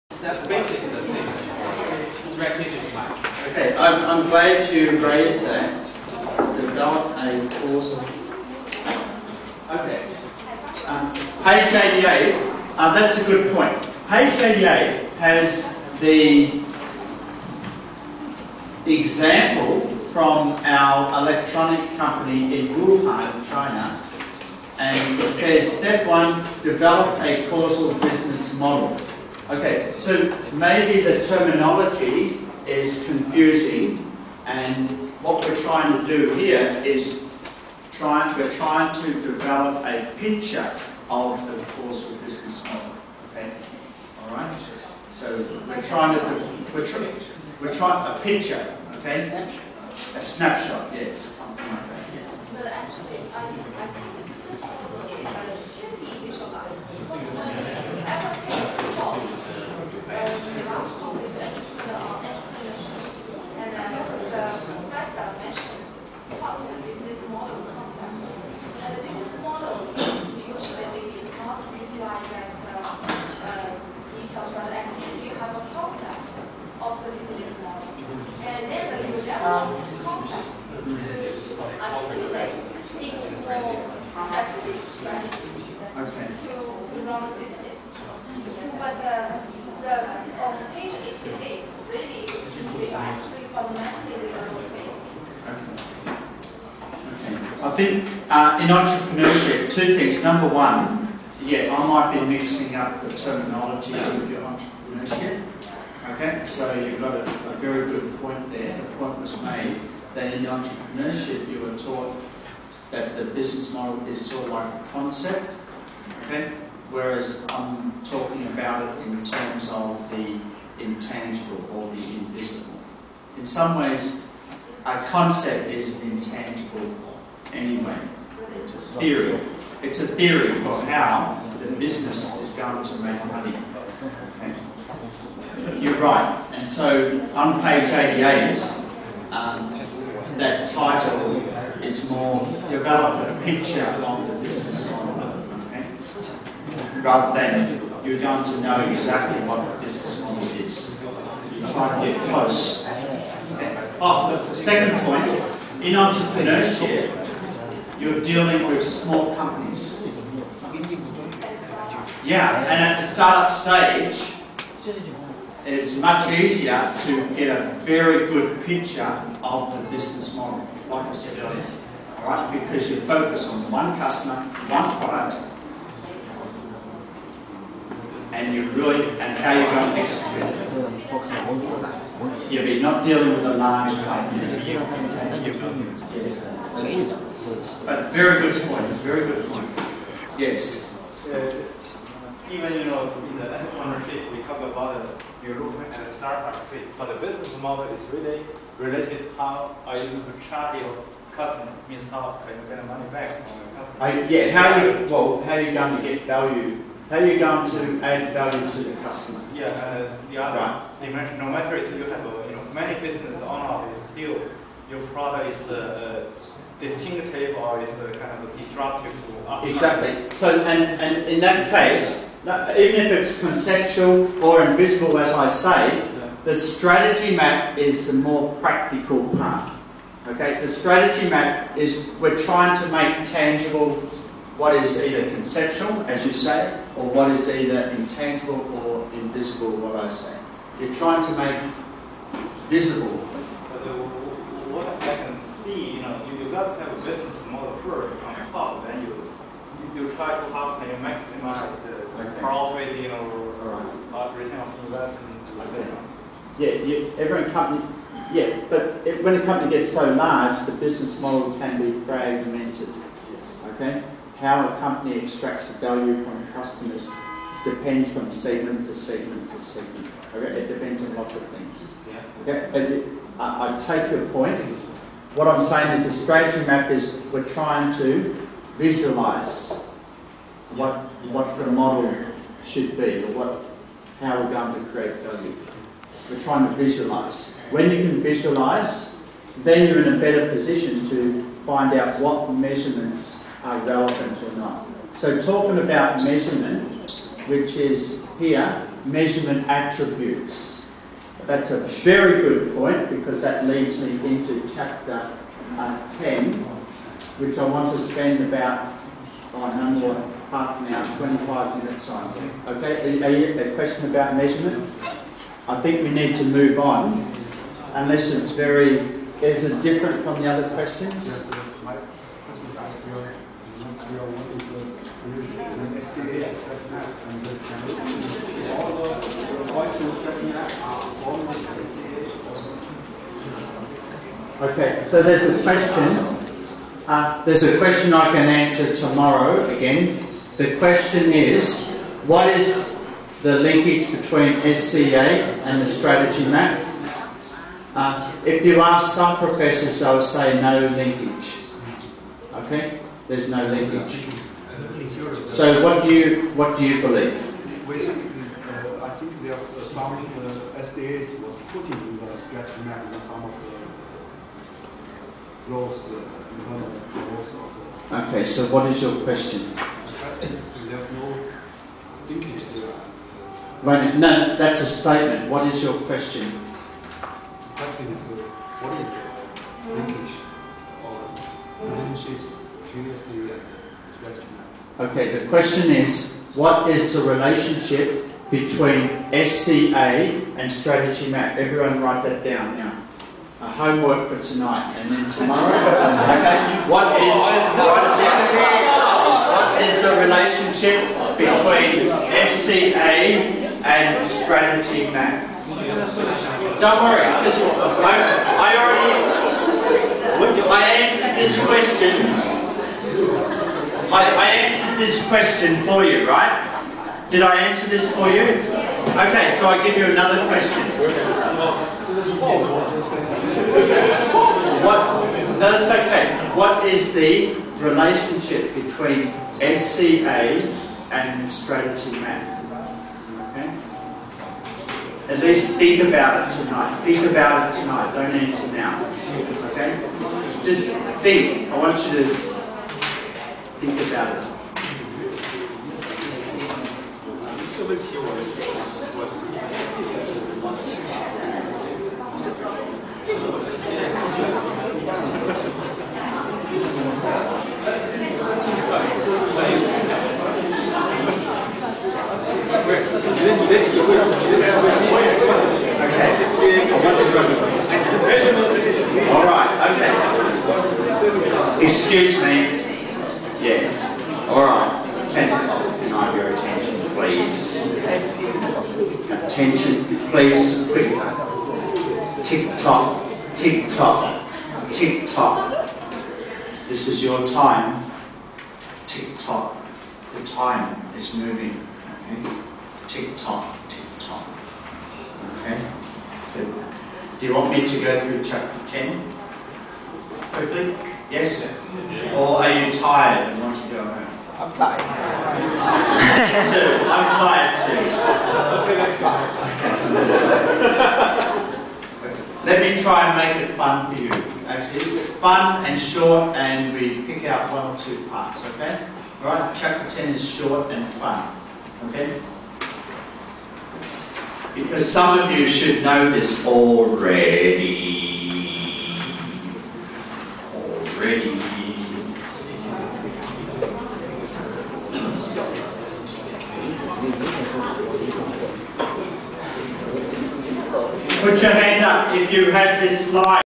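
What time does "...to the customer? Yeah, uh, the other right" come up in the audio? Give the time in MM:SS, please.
03:28.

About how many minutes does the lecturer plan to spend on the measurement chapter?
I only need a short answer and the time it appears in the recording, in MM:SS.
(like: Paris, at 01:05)
25 minutes, at 05:11.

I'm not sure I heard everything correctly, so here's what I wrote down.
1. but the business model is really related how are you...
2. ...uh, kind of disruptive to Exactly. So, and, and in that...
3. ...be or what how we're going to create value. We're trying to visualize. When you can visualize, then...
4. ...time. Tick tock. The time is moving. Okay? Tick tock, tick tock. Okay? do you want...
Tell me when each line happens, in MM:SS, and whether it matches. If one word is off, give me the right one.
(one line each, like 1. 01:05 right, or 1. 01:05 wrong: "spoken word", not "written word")
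1. 03:16 right
2. 03:37 right
3. 04:42 right
4. 08:07 right.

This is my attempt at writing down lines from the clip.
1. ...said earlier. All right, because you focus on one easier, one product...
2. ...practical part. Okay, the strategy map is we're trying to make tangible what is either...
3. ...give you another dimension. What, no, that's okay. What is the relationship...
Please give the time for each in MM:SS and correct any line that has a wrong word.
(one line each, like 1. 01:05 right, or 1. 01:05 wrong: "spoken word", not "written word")
1. 02:51 wrong: "customer", not "easier"
2. 03:48 right
3. 06:59 wrong: "question", not "dimension".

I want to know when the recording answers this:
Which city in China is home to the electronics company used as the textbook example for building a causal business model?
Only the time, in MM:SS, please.
00:22.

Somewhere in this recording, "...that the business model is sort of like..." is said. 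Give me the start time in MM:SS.
01:52.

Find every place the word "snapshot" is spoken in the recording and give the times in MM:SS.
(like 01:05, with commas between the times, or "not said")
00:50.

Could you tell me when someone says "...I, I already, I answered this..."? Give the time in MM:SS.
06:48.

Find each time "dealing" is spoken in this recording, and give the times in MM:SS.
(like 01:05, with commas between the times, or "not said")
02:38, 03:03.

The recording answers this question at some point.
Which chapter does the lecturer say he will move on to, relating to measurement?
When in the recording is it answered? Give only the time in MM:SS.
05:04.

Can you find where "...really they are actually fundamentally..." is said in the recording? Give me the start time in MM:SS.
01:31.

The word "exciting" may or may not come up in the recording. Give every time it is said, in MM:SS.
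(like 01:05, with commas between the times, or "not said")
not said.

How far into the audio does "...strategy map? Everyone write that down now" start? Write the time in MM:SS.
06:30.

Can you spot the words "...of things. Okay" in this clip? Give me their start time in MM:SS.
04:31.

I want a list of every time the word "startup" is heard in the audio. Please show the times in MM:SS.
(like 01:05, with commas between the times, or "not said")
02:43, 03:16.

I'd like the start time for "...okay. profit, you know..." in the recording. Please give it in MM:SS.
04:12.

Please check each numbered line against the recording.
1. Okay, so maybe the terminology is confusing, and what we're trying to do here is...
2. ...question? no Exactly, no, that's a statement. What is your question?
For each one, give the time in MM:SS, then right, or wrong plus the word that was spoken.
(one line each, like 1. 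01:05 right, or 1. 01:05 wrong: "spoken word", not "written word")
1. 00:29 right
2. 06:09 wrong: "Right", not "Exactly".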